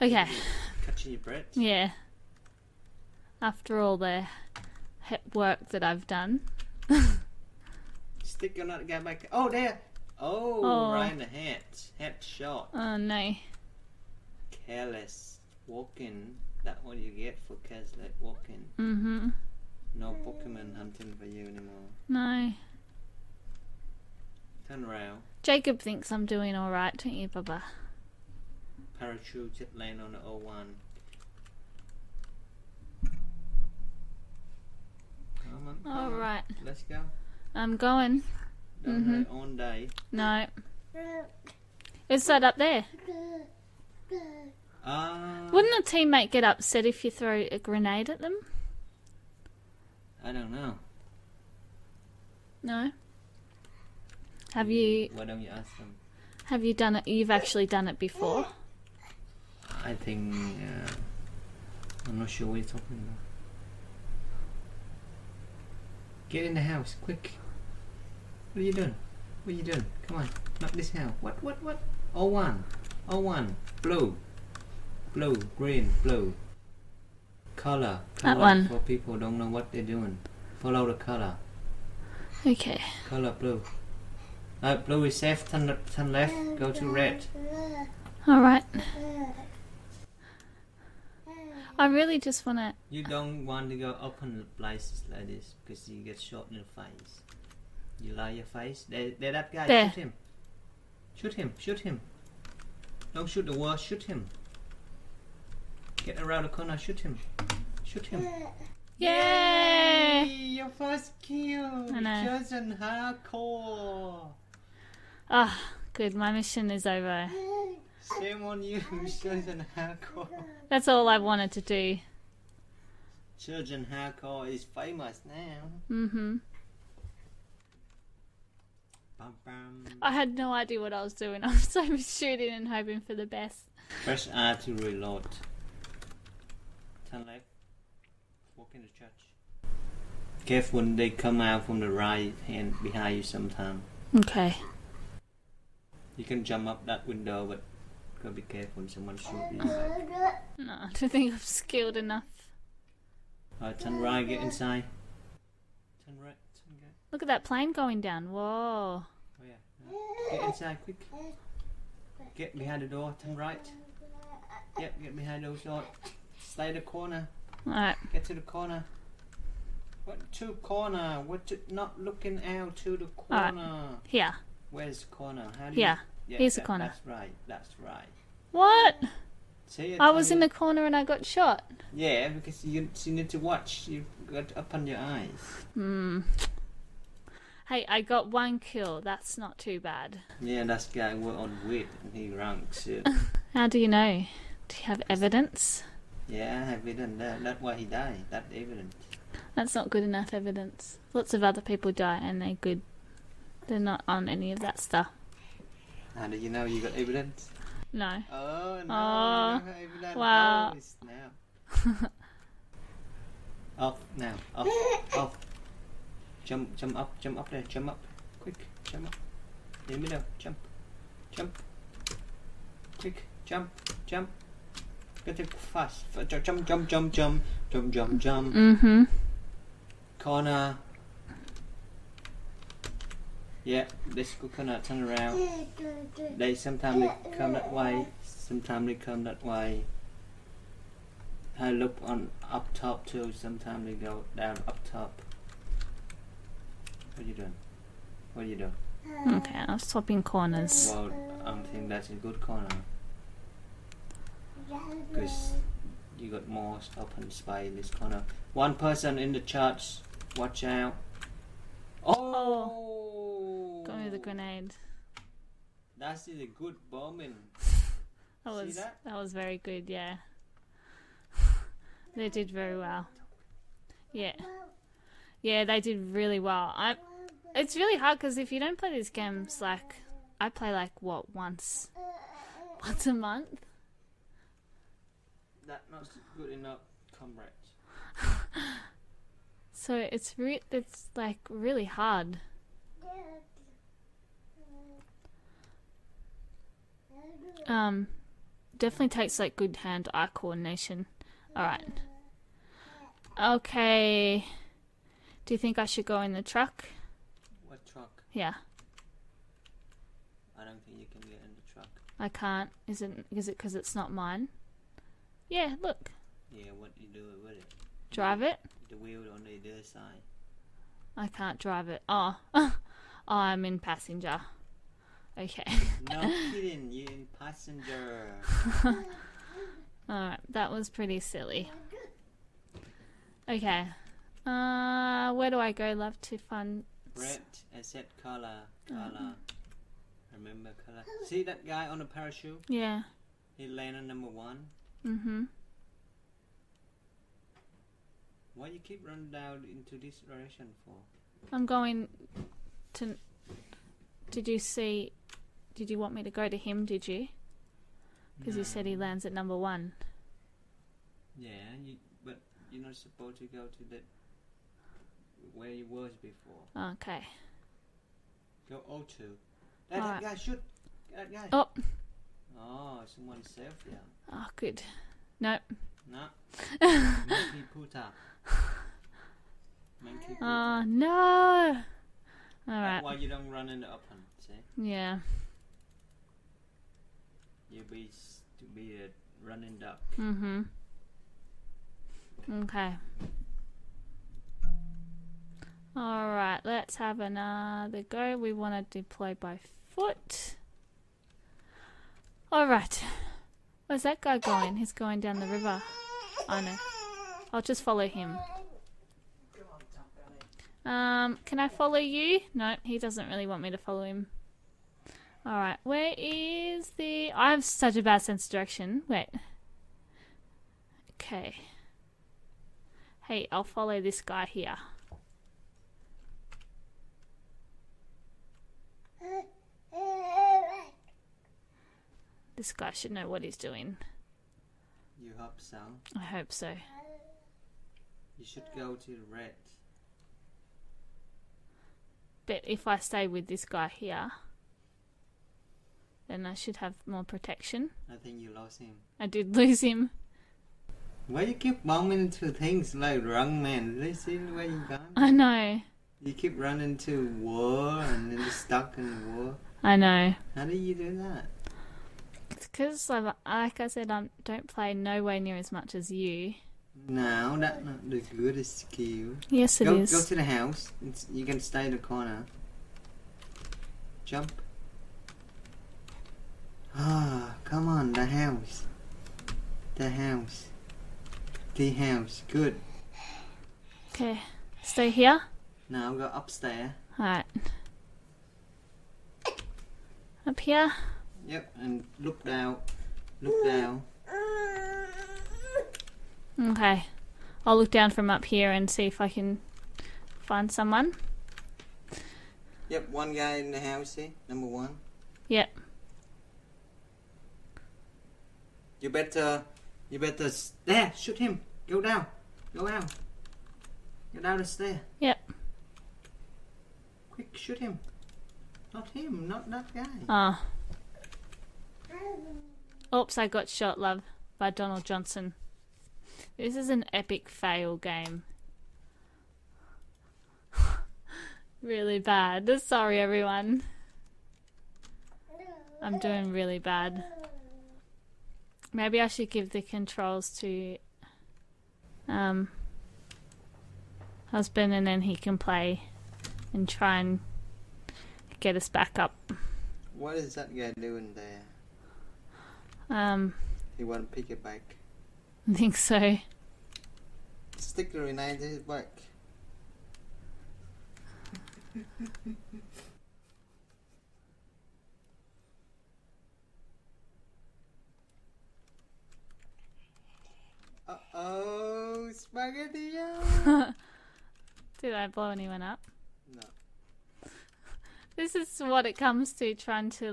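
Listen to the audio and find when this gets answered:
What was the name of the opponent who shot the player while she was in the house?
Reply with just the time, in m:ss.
8:44.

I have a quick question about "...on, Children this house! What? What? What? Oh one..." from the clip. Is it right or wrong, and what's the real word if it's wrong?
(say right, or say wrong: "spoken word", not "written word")
wrong: "Not", not "Children".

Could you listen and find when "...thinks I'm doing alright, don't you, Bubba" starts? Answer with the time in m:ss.
0:25.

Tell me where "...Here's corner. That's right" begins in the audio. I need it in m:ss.
2:56.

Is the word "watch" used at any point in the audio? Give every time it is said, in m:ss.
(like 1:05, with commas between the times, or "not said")
3:03, 4:20.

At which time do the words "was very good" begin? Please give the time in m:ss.
4:29.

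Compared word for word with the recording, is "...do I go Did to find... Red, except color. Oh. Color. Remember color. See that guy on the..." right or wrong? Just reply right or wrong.
wrong.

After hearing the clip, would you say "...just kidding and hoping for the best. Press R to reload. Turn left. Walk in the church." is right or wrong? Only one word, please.
wrong.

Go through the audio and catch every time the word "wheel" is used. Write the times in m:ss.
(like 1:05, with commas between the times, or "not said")
5:18.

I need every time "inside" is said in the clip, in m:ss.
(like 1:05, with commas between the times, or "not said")
2:34, 2:40.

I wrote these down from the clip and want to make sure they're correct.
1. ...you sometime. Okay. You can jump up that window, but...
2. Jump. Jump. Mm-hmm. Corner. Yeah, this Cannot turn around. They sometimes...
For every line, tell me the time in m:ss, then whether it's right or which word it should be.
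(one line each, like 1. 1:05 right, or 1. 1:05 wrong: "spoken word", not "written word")
1. 2:23 right
2. 3:47 right.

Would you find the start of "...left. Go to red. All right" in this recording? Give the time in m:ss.
1:26.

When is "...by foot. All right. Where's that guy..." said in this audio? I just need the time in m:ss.
6:39.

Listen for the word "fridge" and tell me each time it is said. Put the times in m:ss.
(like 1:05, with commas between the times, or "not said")
not said.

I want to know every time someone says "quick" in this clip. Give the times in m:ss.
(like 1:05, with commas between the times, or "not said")
1:07, 2:40, 3:38, 3:42, 8:37.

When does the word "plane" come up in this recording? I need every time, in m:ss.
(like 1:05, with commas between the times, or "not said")
2:37.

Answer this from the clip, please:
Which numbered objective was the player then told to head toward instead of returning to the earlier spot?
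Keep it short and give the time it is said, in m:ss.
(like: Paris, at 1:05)
O2, at 6:08.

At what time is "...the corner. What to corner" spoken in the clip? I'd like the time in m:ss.
2:48.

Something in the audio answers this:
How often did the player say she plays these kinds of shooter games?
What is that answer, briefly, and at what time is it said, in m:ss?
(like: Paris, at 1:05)
Once a month, at 4:42.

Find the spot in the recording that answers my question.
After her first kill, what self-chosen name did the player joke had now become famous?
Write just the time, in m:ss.
2:03.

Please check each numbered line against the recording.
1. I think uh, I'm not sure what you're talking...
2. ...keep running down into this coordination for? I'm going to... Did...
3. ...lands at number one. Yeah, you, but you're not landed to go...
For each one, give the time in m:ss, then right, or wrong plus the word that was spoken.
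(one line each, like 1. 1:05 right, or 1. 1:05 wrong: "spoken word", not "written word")
1. 0:59 right
2. 5:48 wrong: "direction", not "coordination"
3. 5:58 wrong: "supposed", not "landed".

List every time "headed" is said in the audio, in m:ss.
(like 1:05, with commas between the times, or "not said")
not said.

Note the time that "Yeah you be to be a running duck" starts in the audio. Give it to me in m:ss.
6:24.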